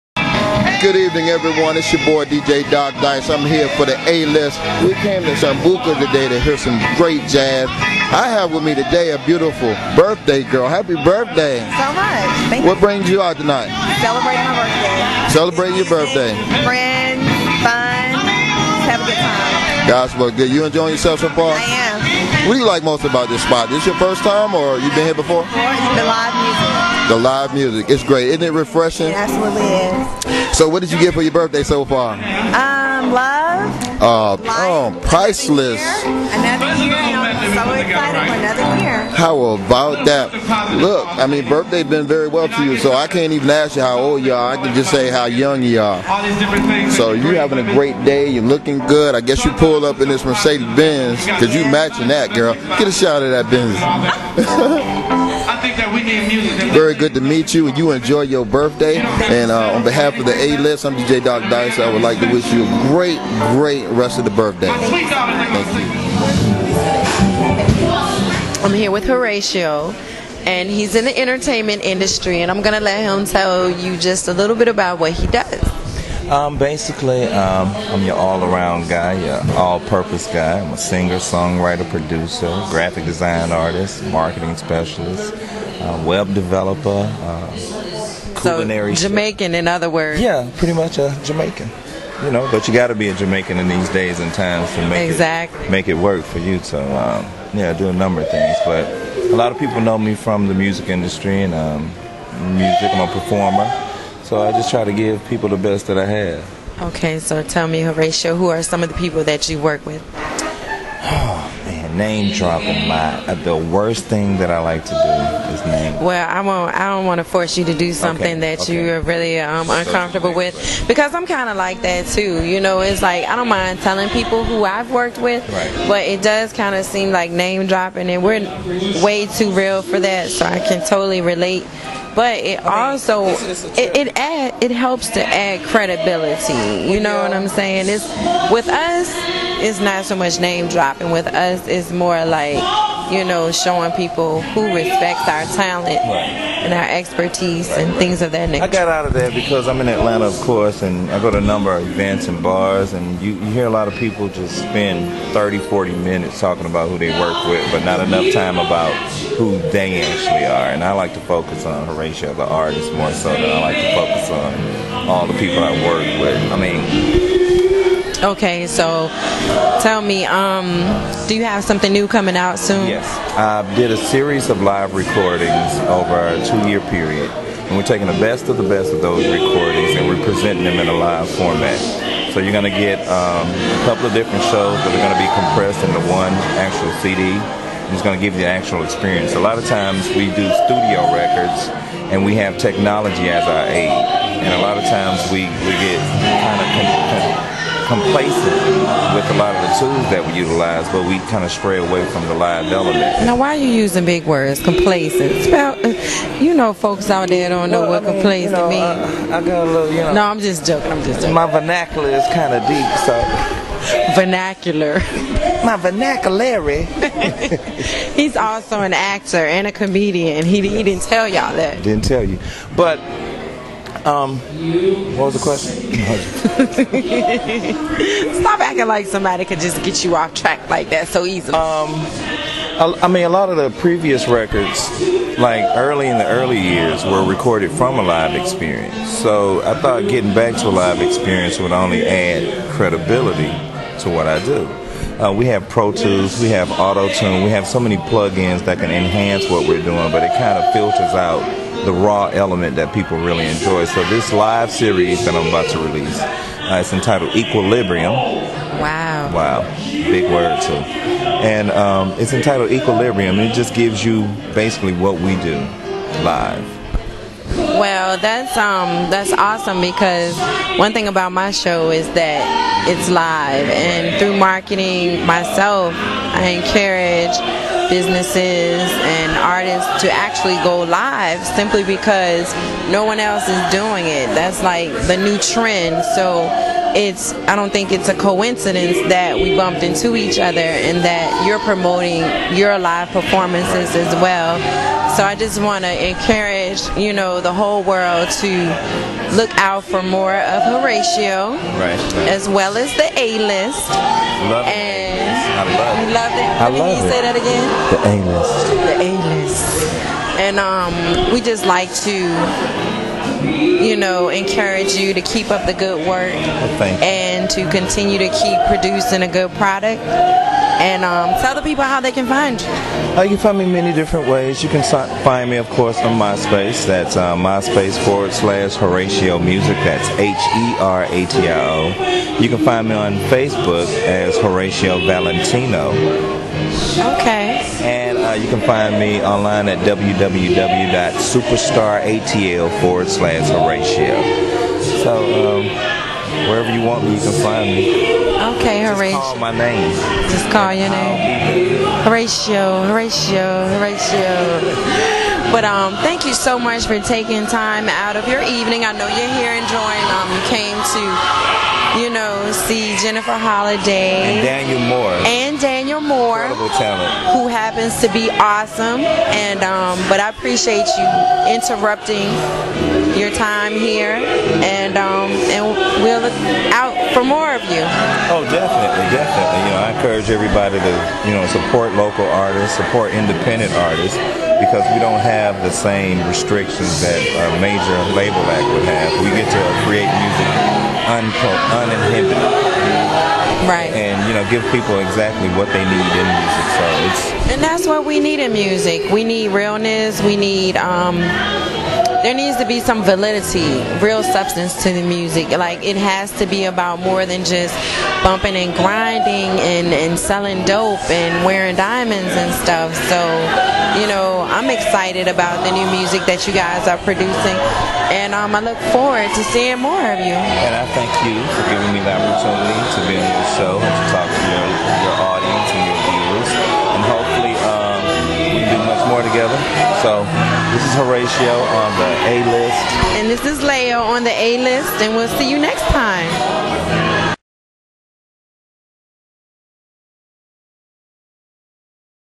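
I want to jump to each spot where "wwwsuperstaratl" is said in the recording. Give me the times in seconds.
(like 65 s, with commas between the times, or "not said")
339 s.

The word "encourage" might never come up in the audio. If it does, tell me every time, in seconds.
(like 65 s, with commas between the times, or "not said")
276 s, 296 s, 314 s, 379 s.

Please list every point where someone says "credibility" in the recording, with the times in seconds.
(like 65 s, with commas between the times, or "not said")
135 s, 242 s.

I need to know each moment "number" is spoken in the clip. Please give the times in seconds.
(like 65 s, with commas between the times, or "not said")
97 s, 151 s.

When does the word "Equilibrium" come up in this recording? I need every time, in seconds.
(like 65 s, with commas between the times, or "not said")
257 s, 262 s.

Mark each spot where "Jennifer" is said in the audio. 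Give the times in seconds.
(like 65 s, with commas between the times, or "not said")
363 s.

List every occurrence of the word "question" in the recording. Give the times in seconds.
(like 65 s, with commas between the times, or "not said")
225 s.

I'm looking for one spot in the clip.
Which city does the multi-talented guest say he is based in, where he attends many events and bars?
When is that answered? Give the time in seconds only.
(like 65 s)
149 s.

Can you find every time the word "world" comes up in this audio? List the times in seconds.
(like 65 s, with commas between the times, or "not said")
297 s.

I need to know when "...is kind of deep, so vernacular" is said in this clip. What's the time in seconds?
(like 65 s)
212 s.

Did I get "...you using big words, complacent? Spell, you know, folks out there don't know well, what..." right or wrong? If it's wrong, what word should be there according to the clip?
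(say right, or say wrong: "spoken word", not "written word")
right.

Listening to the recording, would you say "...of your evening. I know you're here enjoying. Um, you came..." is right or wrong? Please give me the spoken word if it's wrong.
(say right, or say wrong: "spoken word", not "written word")
right.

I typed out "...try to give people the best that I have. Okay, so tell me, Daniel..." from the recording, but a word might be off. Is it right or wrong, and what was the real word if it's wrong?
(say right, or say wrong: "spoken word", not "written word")
wrong: "Heratio", not "Daniel".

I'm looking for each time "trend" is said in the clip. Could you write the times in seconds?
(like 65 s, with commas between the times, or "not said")
285 s.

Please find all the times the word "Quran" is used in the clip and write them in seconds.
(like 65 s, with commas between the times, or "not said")
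not said.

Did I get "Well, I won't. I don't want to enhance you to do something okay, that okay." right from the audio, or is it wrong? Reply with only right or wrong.
wrong.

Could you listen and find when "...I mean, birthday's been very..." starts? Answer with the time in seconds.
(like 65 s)
41 s.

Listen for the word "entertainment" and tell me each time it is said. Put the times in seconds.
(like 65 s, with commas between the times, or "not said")
71 s.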